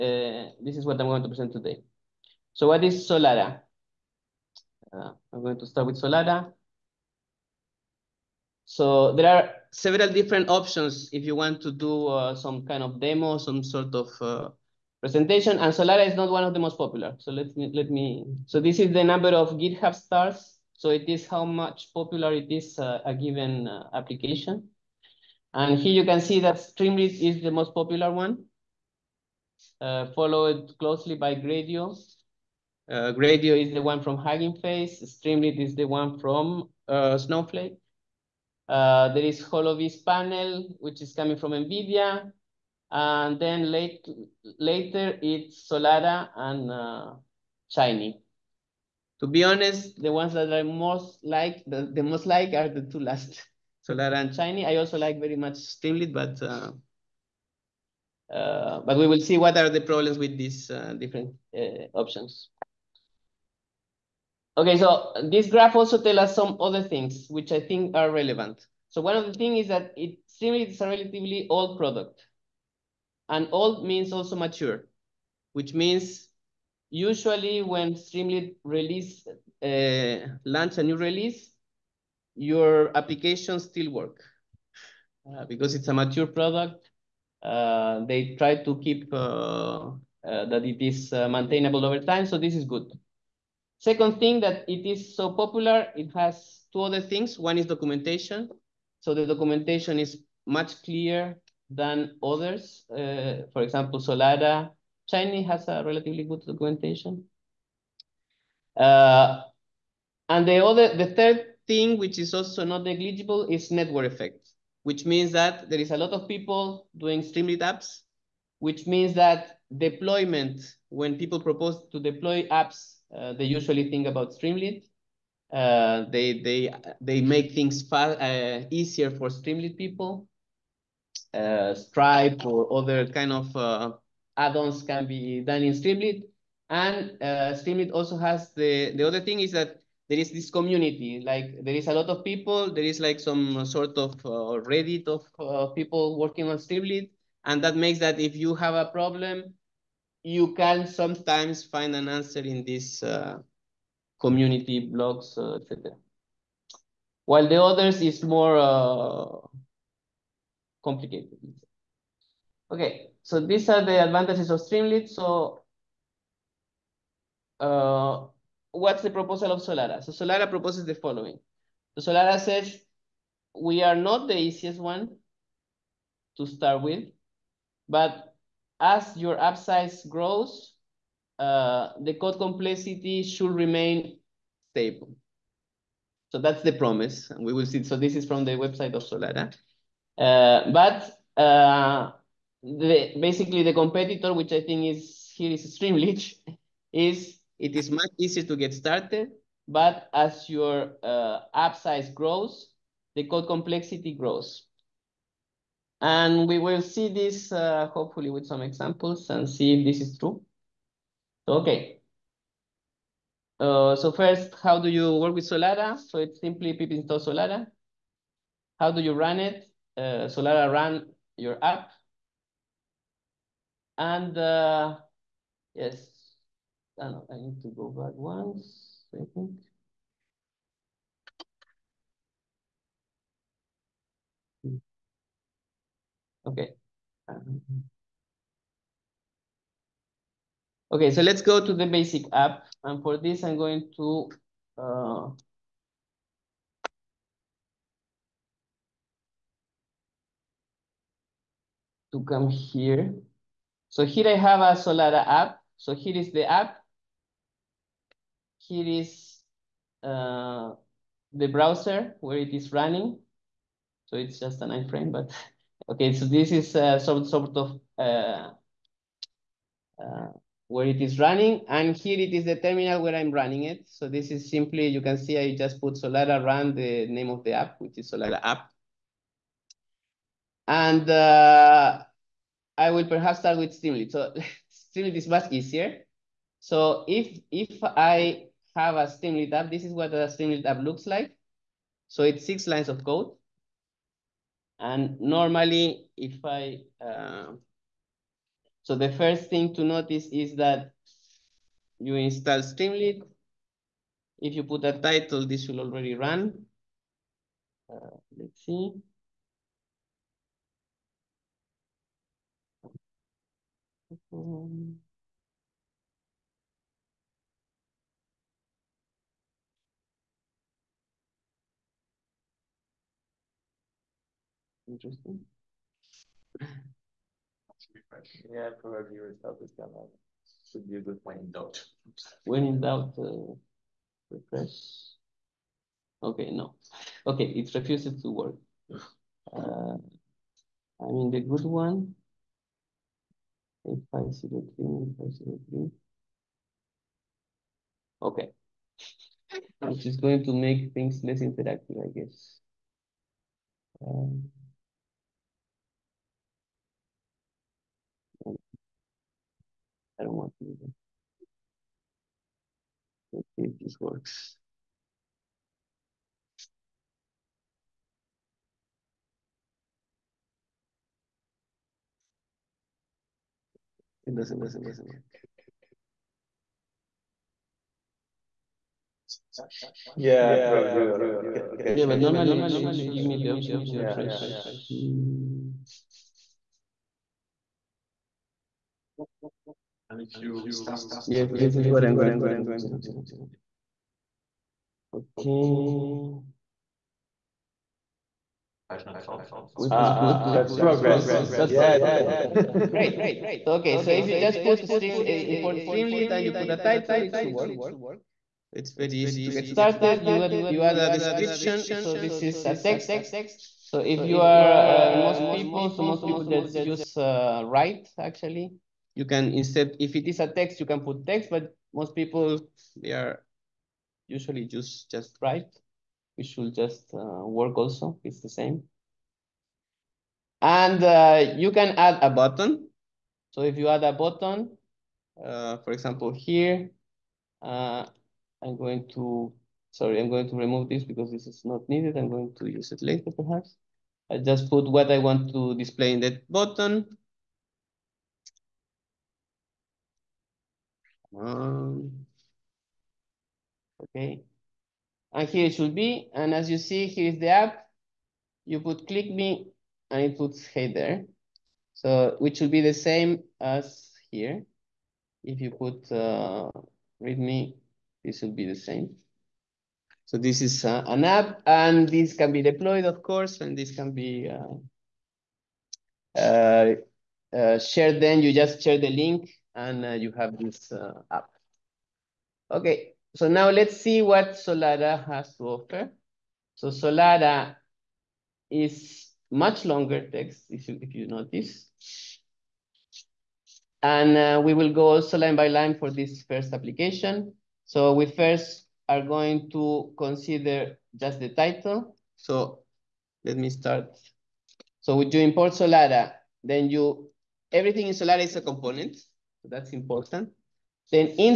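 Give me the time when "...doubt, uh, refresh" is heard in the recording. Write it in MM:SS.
05:32.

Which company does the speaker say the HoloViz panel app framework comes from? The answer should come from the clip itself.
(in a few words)
NVIDIA.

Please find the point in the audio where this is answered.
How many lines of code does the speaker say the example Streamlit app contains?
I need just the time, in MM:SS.
04:52.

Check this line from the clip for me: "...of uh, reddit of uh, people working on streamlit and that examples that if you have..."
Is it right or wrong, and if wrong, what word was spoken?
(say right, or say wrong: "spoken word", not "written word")
wrong: "makes", not "examples".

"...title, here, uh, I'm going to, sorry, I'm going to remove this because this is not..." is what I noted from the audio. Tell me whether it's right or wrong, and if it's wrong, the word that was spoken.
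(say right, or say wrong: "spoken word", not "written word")
wrong: "example", not "title".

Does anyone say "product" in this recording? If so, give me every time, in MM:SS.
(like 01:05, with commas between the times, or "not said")
01:11, 01:26.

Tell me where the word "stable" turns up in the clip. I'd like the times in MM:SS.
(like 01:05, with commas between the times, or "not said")
03:04.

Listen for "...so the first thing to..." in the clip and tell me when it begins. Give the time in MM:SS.
04:58.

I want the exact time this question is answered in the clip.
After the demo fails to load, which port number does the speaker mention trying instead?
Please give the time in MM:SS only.
05:43.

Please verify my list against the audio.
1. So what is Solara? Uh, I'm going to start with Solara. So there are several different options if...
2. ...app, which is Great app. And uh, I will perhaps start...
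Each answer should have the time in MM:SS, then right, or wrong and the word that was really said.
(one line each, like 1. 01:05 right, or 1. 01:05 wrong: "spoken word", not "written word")
1. 00:02 right
2. 04:37 wrong: "Solara", not "Great".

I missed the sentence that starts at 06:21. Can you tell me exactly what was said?
Yeah, but normally it should give me the option to refresh.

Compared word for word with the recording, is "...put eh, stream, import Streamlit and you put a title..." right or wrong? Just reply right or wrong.
right.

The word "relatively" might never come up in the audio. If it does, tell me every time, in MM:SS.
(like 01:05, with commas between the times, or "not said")
01:10, 01:45.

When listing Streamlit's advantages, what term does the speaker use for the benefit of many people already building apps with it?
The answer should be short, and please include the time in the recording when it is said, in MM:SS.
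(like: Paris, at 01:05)
Network effect, at 01:53.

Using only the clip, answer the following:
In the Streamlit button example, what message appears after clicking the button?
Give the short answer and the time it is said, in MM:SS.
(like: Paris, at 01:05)
Hey there, at 07:40.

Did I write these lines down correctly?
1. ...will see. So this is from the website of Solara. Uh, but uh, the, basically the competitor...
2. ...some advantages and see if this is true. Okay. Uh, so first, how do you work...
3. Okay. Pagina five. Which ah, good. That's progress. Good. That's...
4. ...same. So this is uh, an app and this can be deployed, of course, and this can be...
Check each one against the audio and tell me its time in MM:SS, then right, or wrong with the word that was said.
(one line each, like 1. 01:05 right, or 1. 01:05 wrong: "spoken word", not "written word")
1. 03:07 right
2. 03:28 wrong: "examples", not "advantages"
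3. 06:35 wrong: "four", not "five"
4. 07:48 right.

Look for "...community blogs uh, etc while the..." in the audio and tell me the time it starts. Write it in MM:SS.
02:34.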